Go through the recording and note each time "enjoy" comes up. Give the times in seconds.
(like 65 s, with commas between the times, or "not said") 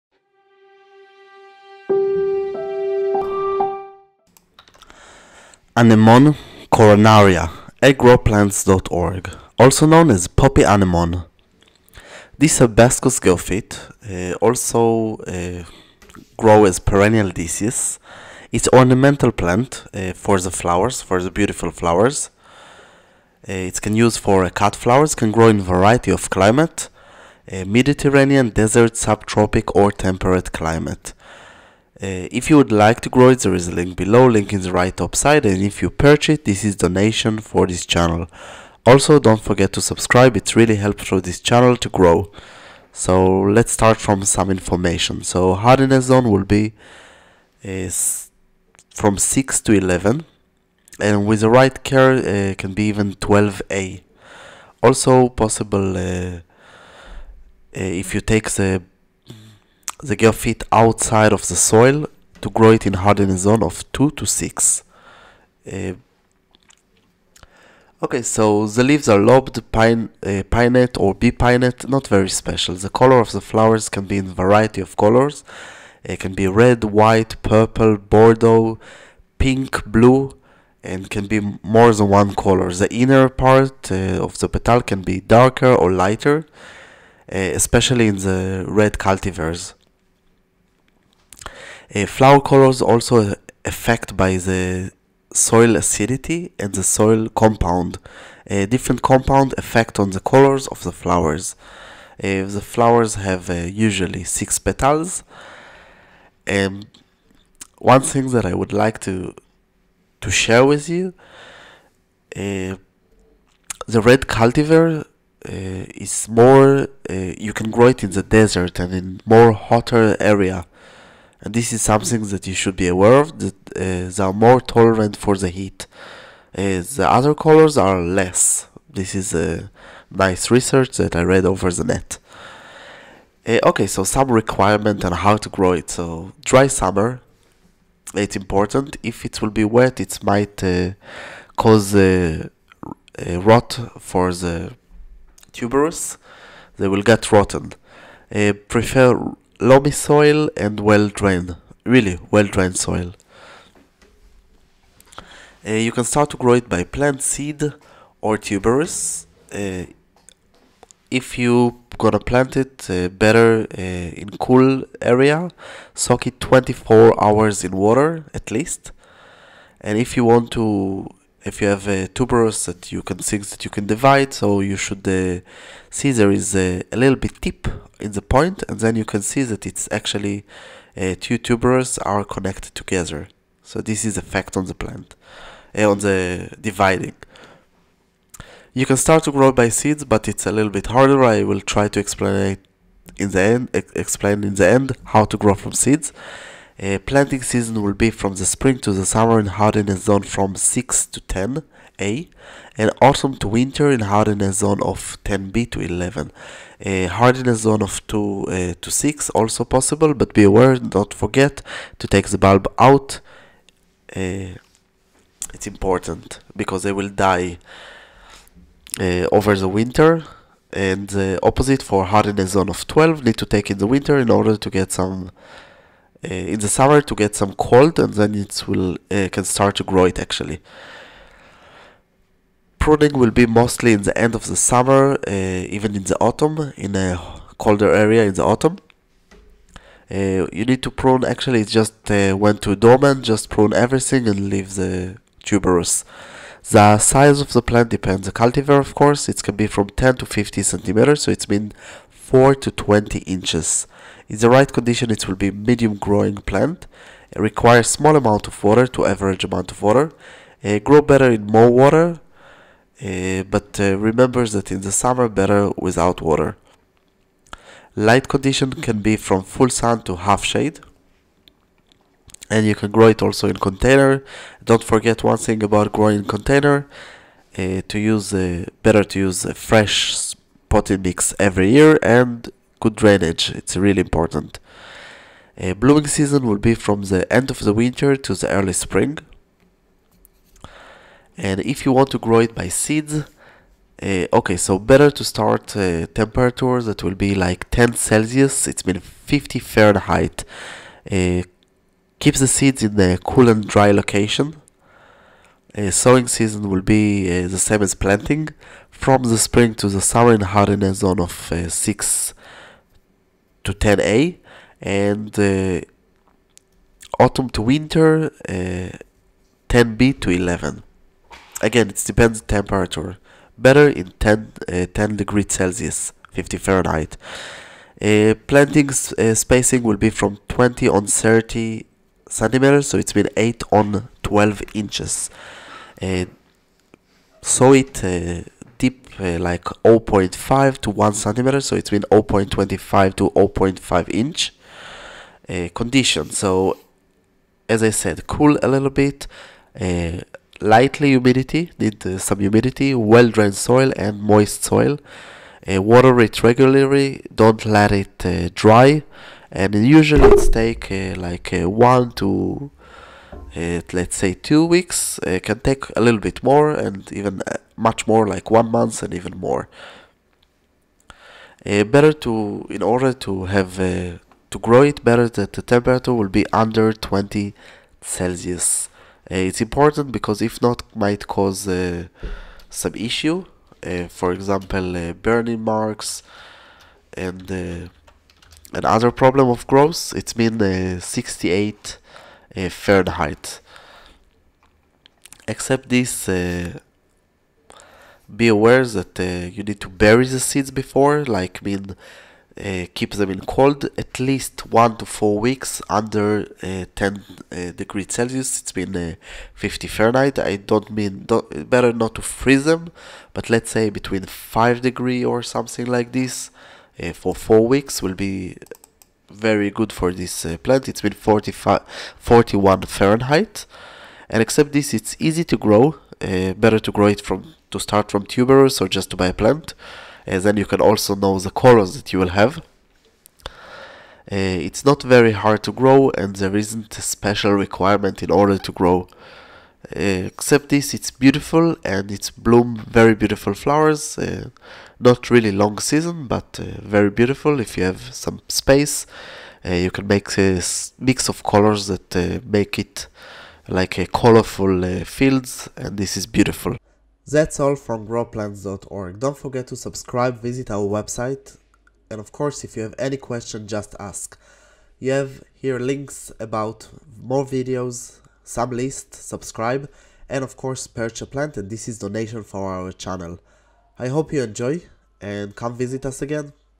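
474 s.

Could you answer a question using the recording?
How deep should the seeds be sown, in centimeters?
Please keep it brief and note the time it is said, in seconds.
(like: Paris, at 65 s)
0.5 to 1 centimeter, at 339 s.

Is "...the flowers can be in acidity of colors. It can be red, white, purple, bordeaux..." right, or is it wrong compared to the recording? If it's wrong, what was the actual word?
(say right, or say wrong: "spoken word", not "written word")
wrong: "variety", not "acidity".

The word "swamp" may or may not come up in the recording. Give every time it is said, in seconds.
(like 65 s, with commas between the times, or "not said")
not said.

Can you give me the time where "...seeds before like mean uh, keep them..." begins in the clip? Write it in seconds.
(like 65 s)
400 s.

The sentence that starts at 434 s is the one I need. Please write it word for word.
Uh, it's not very hard to grow and there isn't a special requirement in order to grow.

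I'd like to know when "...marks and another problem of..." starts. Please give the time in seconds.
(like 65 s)
385 s.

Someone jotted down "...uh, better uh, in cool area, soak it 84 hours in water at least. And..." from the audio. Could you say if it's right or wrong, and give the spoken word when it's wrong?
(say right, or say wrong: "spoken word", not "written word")
wrong: "24", not "84".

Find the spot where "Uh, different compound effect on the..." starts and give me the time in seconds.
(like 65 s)
98 s.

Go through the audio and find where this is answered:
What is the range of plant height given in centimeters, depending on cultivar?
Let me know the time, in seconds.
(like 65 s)
249 s.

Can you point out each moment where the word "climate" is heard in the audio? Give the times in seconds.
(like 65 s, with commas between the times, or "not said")
26 s, 30 s.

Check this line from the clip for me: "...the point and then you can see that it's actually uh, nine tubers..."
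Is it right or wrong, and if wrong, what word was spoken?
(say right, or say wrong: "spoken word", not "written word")
wrong: "two", not "nine".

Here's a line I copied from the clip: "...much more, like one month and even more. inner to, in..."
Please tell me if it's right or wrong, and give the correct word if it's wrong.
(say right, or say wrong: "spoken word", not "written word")
wrong: "better", not "inner".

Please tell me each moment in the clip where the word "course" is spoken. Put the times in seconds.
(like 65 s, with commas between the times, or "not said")
248 s, 462 s, 470 s.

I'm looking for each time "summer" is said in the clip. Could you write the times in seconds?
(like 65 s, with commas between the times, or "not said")
136 s, 199 s, 226 s, 234 s, 264 s, 310 s.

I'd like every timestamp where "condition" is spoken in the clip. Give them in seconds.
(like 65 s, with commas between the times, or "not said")
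254 s, 268 s, 345 s.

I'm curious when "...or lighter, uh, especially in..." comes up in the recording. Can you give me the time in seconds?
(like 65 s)
85 s.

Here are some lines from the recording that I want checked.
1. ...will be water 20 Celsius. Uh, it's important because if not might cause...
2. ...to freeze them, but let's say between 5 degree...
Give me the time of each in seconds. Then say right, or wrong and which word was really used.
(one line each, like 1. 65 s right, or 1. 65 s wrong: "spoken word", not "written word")
1. 376 s wrong: "under", not "water"
2. 412 s right.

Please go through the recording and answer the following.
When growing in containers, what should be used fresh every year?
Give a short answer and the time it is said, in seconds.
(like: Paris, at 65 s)
potted mix, at 280 s.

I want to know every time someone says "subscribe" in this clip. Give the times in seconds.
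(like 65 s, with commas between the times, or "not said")
39 s, 459 s, 469 s.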